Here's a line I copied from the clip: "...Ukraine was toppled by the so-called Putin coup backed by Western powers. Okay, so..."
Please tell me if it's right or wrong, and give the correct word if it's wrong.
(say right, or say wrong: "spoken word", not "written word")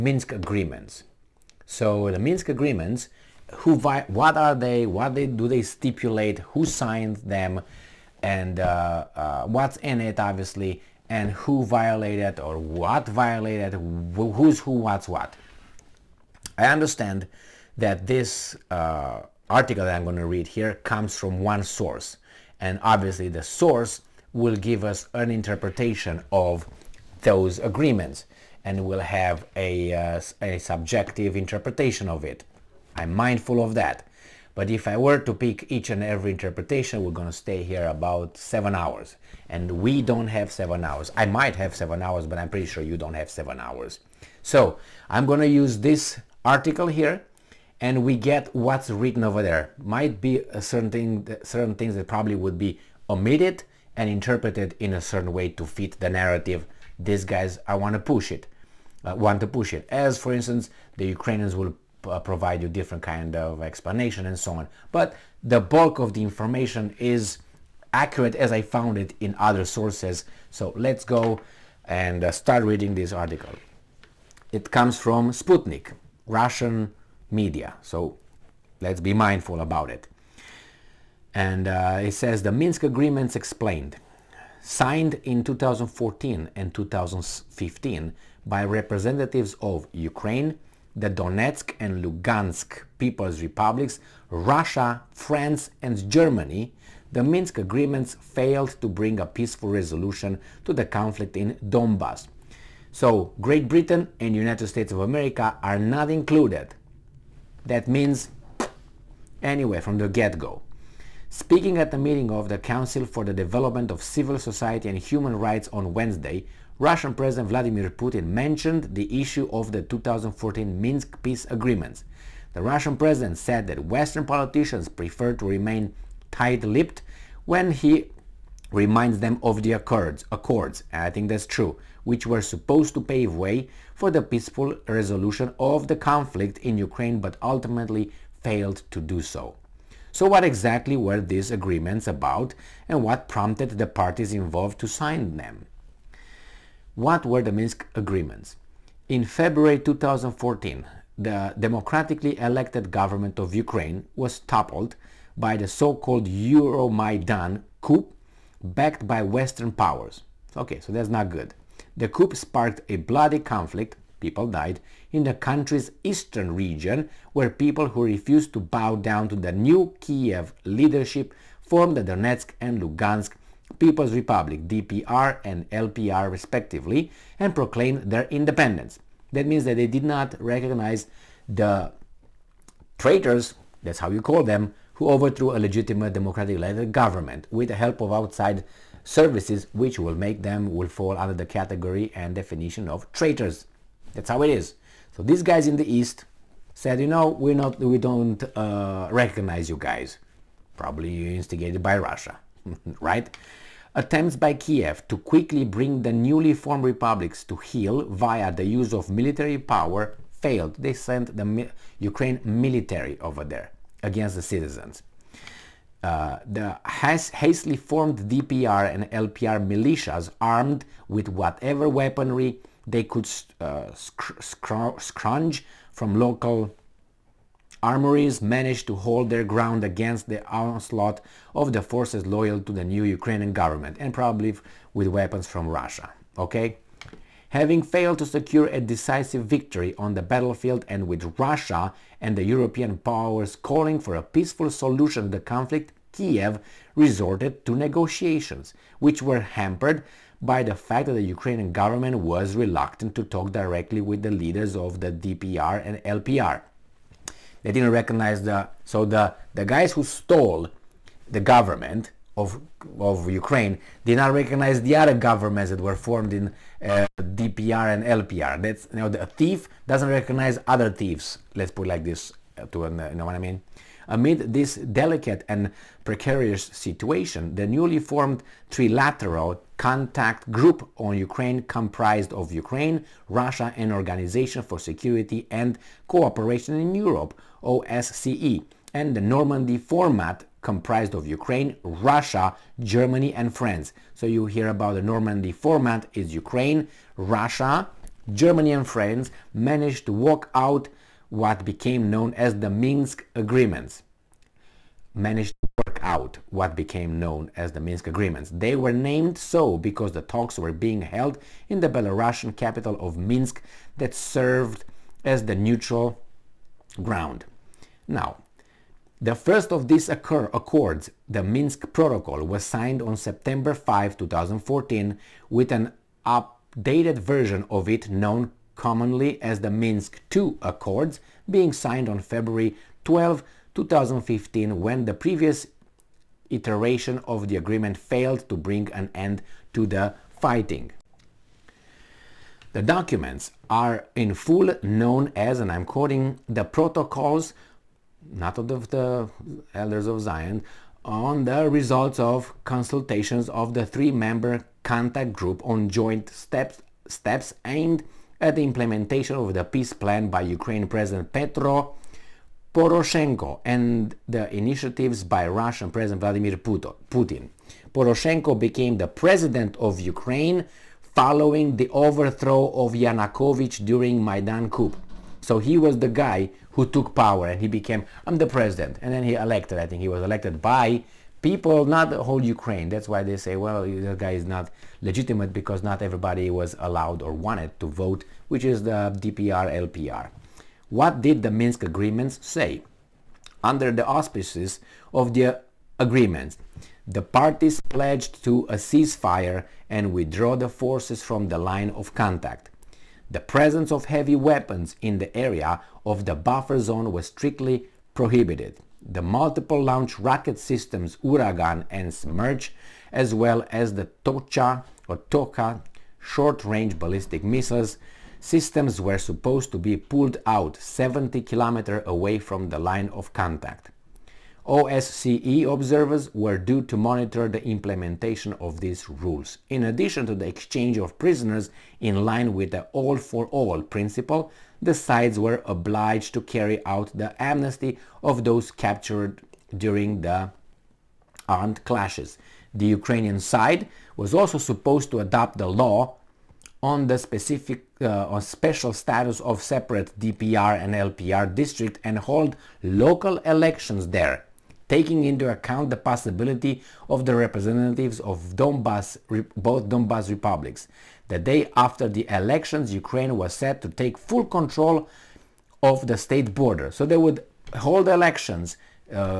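wrong: "Euromaidan", not "Putin".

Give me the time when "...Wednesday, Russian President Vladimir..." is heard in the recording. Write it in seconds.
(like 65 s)
115 s.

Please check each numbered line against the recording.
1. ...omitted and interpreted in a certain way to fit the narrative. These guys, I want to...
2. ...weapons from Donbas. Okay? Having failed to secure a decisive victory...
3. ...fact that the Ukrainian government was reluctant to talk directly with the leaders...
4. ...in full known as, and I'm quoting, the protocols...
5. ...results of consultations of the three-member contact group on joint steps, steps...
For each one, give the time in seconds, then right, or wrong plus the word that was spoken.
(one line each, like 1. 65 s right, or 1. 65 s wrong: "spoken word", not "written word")
1. 53 s right
2. 235 s wrong: "Russia", not "Donbas"
3. 250 s right
4. 344 s right
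5. 351 s right.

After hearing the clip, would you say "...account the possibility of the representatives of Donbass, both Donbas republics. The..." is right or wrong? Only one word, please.
right.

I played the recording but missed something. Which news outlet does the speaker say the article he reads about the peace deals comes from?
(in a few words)
Sputnik.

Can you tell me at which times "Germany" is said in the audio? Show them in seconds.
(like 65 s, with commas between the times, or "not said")
96 s, 292 s, 298 s.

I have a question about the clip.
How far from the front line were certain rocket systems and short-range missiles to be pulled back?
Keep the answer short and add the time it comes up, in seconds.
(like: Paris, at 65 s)
70 km, at 420 s.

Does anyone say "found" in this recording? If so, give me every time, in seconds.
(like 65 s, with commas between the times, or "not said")
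68 s.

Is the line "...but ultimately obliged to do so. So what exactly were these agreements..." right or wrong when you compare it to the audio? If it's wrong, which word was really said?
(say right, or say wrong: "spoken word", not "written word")
wrong: "failed", not "obliged".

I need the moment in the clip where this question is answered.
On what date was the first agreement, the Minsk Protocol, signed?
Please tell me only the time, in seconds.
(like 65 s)
323 s.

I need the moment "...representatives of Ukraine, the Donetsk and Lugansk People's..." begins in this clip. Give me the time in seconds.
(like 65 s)
88 s.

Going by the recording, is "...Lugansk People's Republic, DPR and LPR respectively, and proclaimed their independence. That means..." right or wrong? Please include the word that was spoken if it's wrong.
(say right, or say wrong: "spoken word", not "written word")
right.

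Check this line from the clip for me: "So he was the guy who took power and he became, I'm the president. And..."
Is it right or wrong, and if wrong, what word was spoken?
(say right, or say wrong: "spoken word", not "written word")
right.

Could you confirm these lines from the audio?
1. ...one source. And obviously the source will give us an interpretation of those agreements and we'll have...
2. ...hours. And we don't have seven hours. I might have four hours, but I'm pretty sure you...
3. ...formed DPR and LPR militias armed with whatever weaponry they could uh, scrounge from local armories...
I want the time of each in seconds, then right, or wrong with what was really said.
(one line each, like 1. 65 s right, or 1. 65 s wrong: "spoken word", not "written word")
1. 21 s right
2. 38 s wrong: "seven", not "four"
3. 217 s right.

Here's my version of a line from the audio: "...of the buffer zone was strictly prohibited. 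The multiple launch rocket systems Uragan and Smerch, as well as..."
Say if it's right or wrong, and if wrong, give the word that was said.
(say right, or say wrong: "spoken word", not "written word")
right.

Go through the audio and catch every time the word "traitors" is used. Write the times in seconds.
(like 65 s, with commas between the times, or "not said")
182 s, 193 s.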